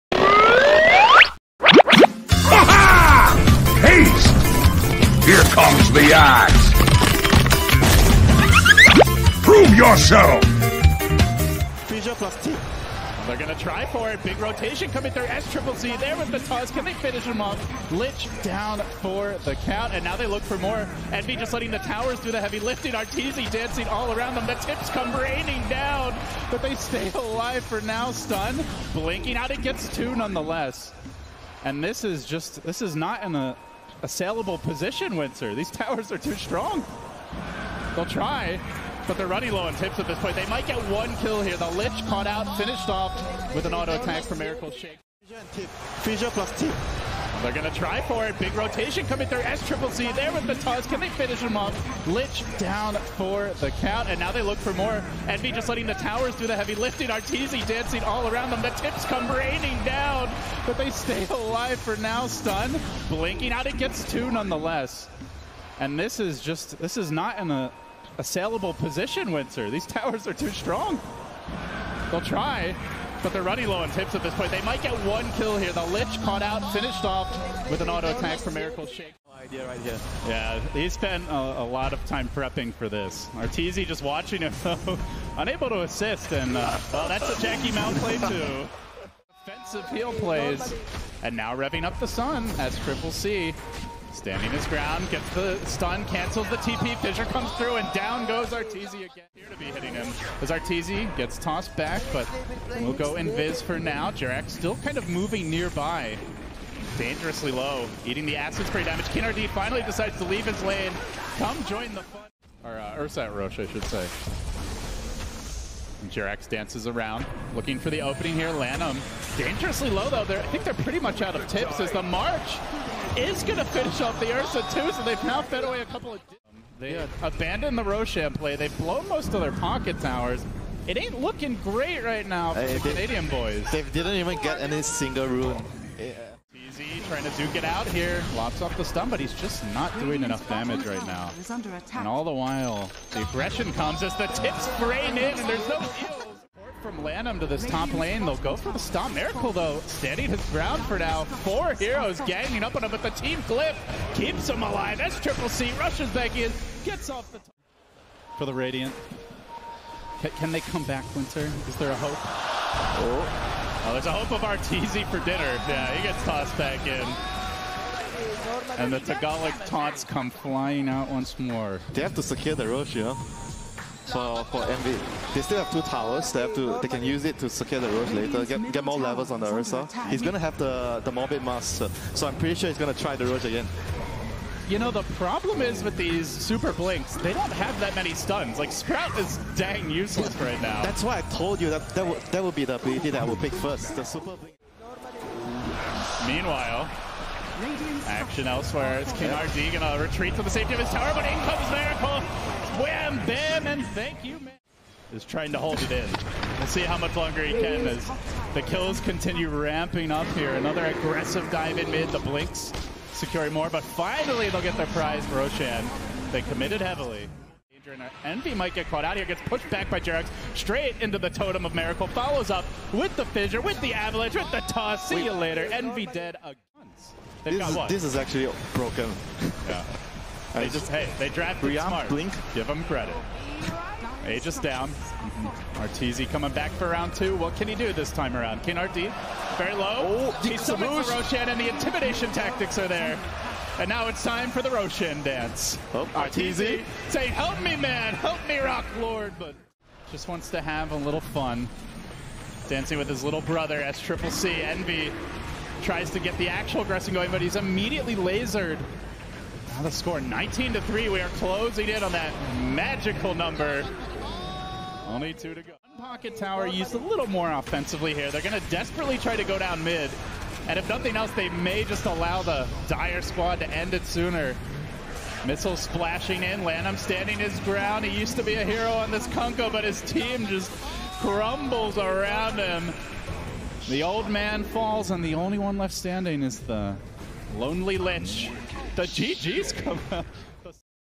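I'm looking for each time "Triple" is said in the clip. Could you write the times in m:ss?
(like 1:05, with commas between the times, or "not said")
0:15, 0:49, 1:32, 2:35, 4:13.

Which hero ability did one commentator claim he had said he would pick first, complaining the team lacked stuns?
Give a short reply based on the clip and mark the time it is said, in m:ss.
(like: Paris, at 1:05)
super blink, at 3:13.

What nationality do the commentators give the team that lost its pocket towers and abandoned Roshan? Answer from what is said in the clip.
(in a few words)
Canadian.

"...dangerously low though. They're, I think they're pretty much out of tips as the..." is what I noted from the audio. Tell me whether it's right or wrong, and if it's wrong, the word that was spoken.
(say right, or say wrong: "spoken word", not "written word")
right.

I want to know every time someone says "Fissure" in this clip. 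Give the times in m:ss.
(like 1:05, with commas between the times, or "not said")
0:46, 1:36, 3:43.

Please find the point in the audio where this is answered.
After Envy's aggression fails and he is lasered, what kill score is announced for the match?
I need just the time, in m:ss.
4:20.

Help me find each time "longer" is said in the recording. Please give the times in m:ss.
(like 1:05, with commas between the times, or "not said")
3:27.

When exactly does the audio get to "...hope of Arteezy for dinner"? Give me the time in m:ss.
2:44.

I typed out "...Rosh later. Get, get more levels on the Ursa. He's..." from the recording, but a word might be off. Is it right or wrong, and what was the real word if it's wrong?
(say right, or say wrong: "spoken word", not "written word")
right.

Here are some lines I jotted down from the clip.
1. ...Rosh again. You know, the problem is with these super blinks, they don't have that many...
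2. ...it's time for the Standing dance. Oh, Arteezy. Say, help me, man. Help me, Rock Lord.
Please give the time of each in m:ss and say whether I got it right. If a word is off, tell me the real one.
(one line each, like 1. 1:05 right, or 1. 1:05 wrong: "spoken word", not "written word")
1. 3:03 right
2. 4:04 wrong: "Roshan", not "Standing".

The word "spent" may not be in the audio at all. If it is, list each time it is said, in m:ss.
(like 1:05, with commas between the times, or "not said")
1:20.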